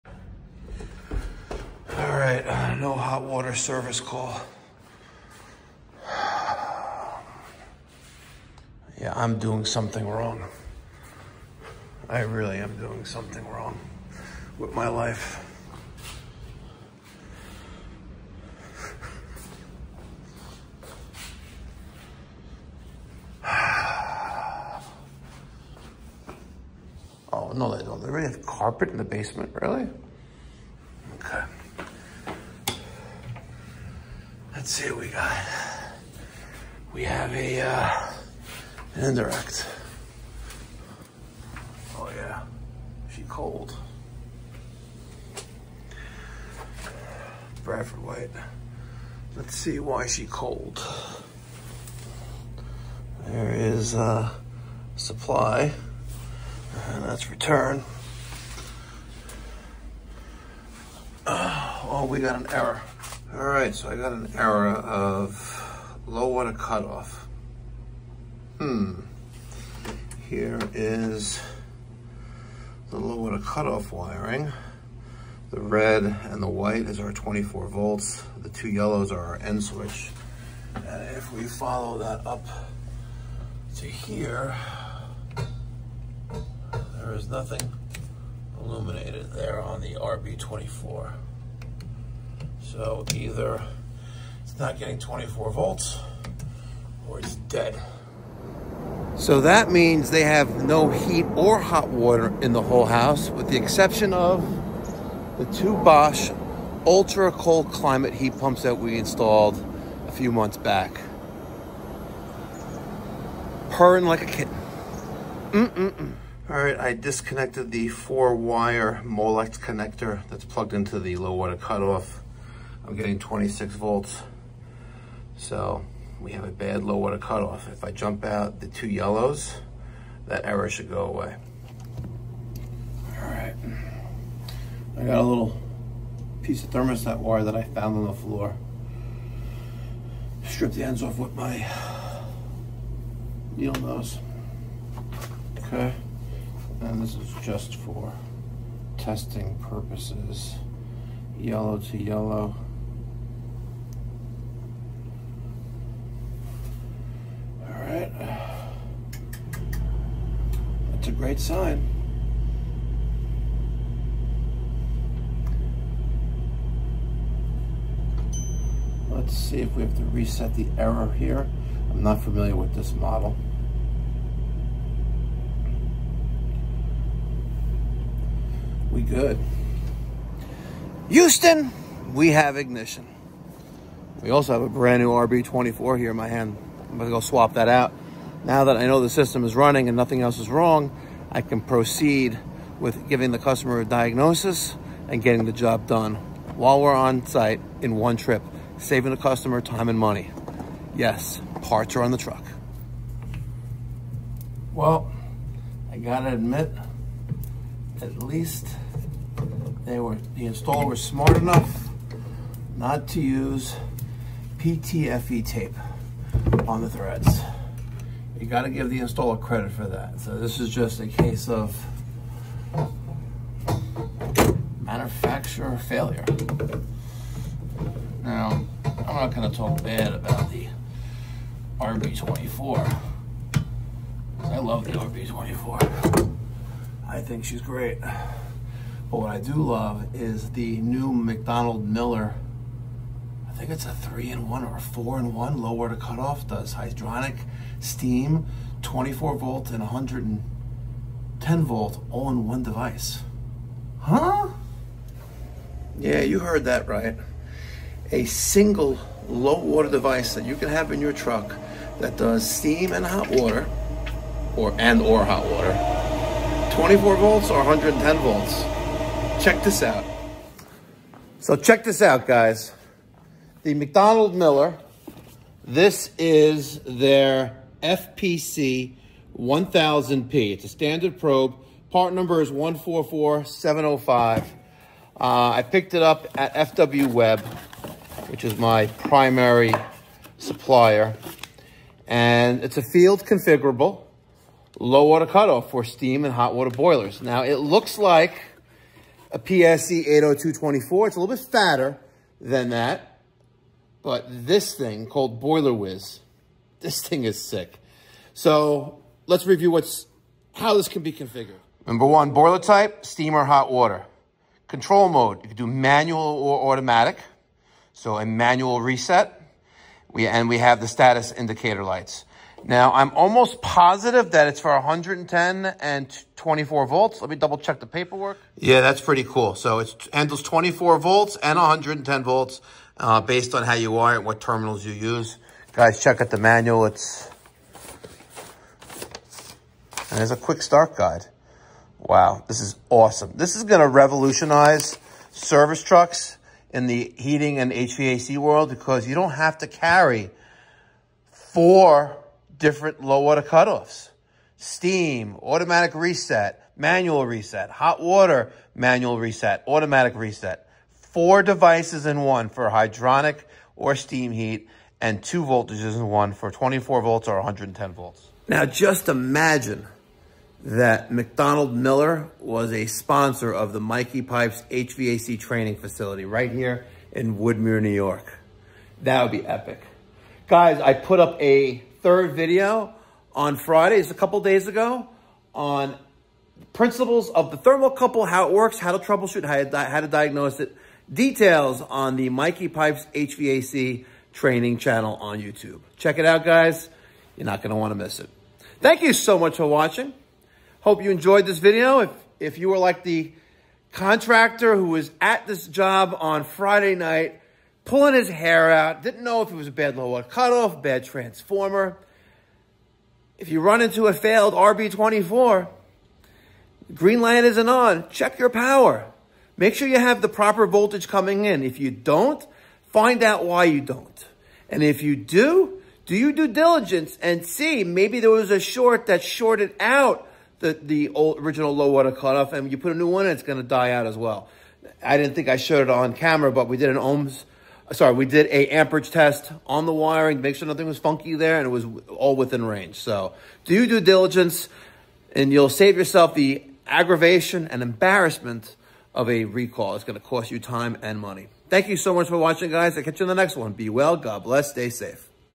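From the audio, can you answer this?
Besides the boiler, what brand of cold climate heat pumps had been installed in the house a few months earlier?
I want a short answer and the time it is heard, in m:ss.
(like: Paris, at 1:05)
Bosch, at 1:45.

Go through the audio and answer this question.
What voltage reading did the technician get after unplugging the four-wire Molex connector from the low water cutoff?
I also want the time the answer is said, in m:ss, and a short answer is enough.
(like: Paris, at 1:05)
26 volts, at 2:03.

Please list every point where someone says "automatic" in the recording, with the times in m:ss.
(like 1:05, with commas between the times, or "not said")
5:16, 5:55, 5:59.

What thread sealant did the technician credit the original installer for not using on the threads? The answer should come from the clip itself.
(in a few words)
PTFE tape.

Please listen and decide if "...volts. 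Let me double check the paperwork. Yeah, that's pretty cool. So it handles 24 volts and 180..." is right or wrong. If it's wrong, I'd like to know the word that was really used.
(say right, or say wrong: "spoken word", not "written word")
wrong: "110", not "180".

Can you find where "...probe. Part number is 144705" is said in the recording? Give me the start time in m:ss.
4:41.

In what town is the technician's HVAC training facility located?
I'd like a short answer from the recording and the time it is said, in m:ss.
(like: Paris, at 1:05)
Woodmere, New York, at 6:17.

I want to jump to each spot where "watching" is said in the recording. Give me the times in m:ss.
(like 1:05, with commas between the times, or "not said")
6:39, 7:32.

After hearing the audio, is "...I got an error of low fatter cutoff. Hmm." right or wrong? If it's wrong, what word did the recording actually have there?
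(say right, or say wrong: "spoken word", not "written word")
wrong: "water", not "fatter".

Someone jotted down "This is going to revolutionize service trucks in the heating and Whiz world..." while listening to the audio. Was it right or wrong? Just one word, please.
wrong.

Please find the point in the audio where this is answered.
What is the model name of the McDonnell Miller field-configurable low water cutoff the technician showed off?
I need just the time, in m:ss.
4:37.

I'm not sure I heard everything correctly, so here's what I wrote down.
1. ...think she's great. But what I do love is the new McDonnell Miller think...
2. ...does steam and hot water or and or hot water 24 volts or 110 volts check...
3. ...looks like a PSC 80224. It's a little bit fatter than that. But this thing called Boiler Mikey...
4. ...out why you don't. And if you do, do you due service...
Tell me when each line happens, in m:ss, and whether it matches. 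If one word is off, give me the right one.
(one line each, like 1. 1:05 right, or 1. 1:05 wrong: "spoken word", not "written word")
1. 3:57 right
2. 4:22 right
3. 4:57 wrong: "Whiz", not "Mikey"
4. 7:03 wrong: "diligence", not "service".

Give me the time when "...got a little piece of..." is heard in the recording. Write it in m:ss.
2:15.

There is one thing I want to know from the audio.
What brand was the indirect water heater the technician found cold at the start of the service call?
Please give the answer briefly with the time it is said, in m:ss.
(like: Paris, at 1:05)
Bradford White, at 0:47.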